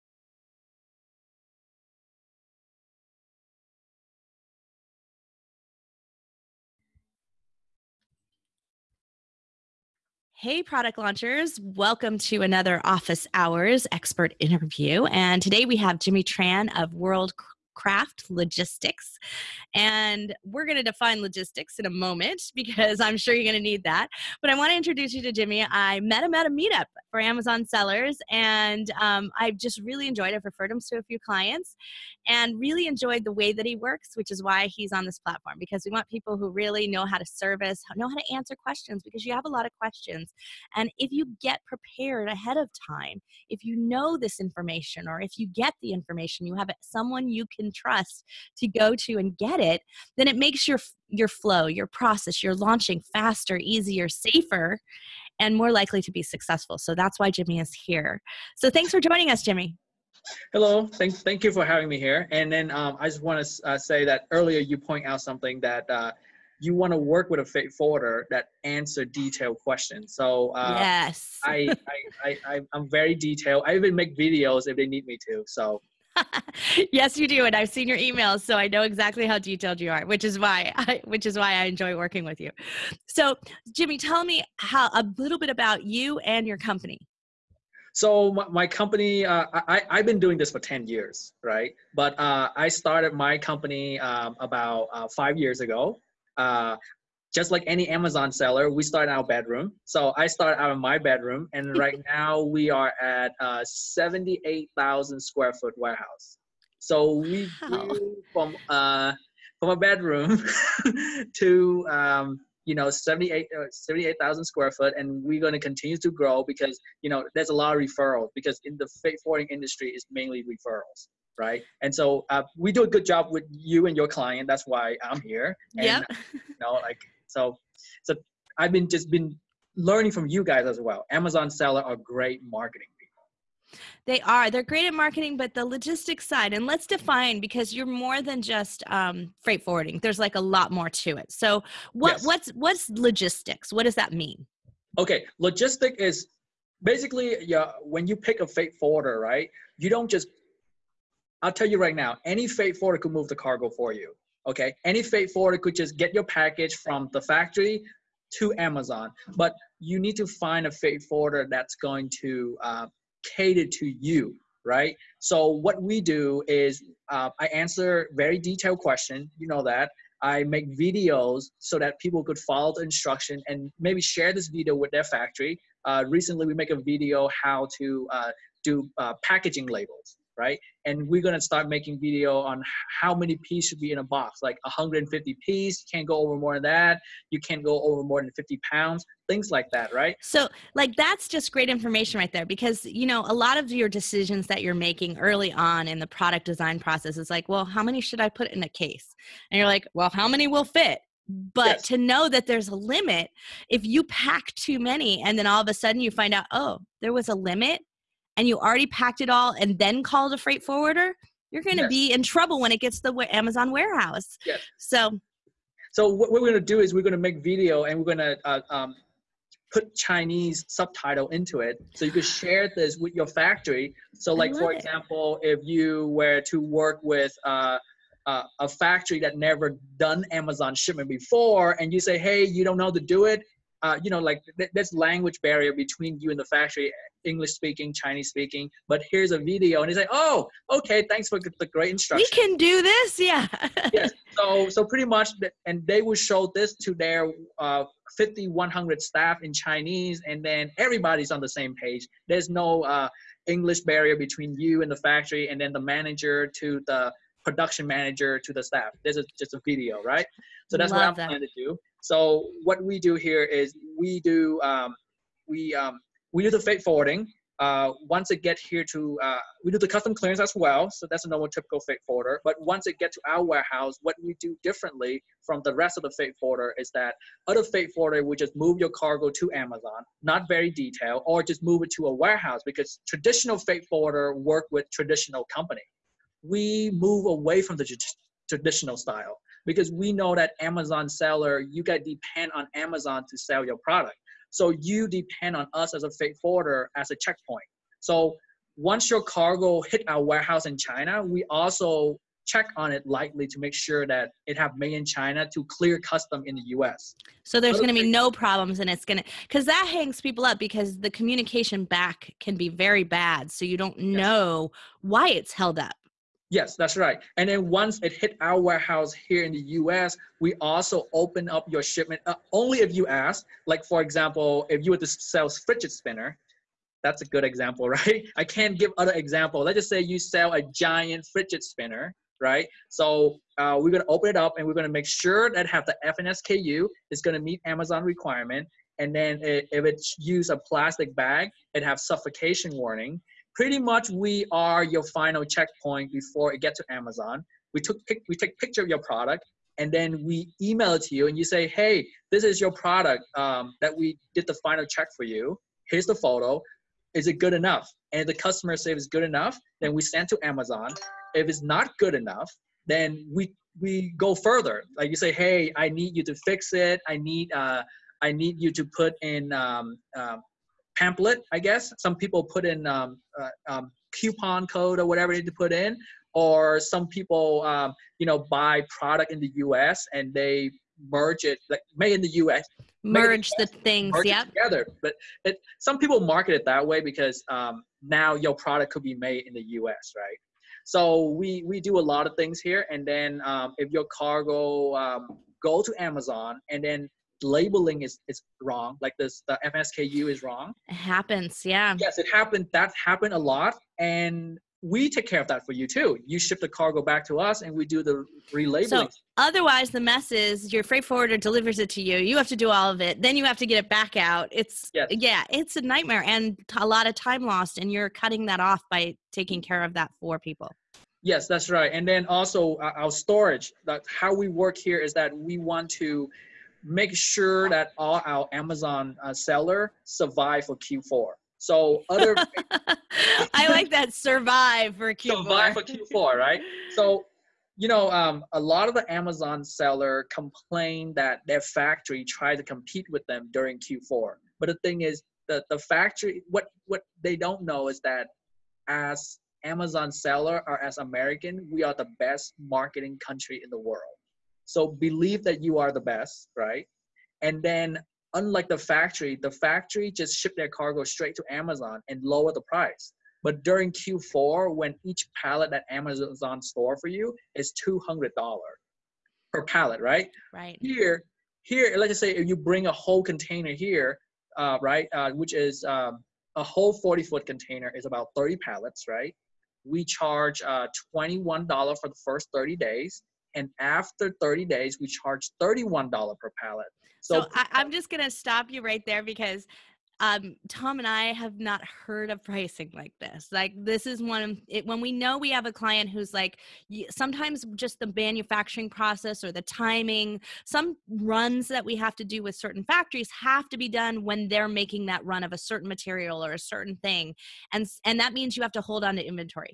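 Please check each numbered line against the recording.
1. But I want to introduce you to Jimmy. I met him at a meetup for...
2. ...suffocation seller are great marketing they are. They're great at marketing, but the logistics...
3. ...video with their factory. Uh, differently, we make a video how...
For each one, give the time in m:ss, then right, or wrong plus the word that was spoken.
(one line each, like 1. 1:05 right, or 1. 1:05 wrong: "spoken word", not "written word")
1. 0:24 right
2. 2:11 wrong: "amazon", not "suffocation"
3. 2:54 wrong: "recently", not "differently".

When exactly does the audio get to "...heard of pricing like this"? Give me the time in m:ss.
8:12.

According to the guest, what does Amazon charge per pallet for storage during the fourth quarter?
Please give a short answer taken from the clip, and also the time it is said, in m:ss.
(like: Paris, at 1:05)
$200, at 7:47.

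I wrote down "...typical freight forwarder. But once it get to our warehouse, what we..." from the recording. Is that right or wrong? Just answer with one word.
right.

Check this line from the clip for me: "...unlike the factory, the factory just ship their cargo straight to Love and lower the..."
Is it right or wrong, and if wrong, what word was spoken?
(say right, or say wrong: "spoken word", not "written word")
wrong: "Amazon", not "Love".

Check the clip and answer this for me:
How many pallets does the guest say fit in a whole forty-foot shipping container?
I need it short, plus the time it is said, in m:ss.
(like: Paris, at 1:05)
30, at 7:58.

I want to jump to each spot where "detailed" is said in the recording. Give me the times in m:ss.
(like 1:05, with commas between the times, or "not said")
1:09, 1:13, 1:19, 2:48, 4:40.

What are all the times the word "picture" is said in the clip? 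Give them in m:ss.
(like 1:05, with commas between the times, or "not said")
5:48.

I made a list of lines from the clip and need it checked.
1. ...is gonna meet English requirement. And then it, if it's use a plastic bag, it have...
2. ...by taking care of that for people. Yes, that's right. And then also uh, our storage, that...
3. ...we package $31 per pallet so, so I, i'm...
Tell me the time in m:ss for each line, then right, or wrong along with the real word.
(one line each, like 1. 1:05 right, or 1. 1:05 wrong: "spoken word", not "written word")
1. 5:37 wrong: "Amazon", not "English"
2. 6:58 right
3. 8:04 wrong: "charge", not "package".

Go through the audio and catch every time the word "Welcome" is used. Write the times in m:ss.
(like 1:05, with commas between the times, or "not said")
0:11.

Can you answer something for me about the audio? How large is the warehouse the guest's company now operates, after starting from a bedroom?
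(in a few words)
78,000 square feet.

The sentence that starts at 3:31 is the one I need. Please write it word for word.
be in trouble when it gets to the Amazon warehouse.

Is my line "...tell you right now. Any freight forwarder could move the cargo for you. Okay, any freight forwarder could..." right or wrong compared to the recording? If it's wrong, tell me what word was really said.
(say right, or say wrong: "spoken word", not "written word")
right.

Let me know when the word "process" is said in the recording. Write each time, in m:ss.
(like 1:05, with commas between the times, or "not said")
0:51, 3:16, 8:18.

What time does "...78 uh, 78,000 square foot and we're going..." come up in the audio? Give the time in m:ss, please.
1:52.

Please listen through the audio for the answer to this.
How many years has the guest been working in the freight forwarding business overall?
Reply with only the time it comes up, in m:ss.
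1:30.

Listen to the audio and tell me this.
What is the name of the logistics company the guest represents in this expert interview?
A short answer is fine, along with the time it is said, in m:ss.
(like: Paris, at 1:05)
World Craft Logistics, at 0:16.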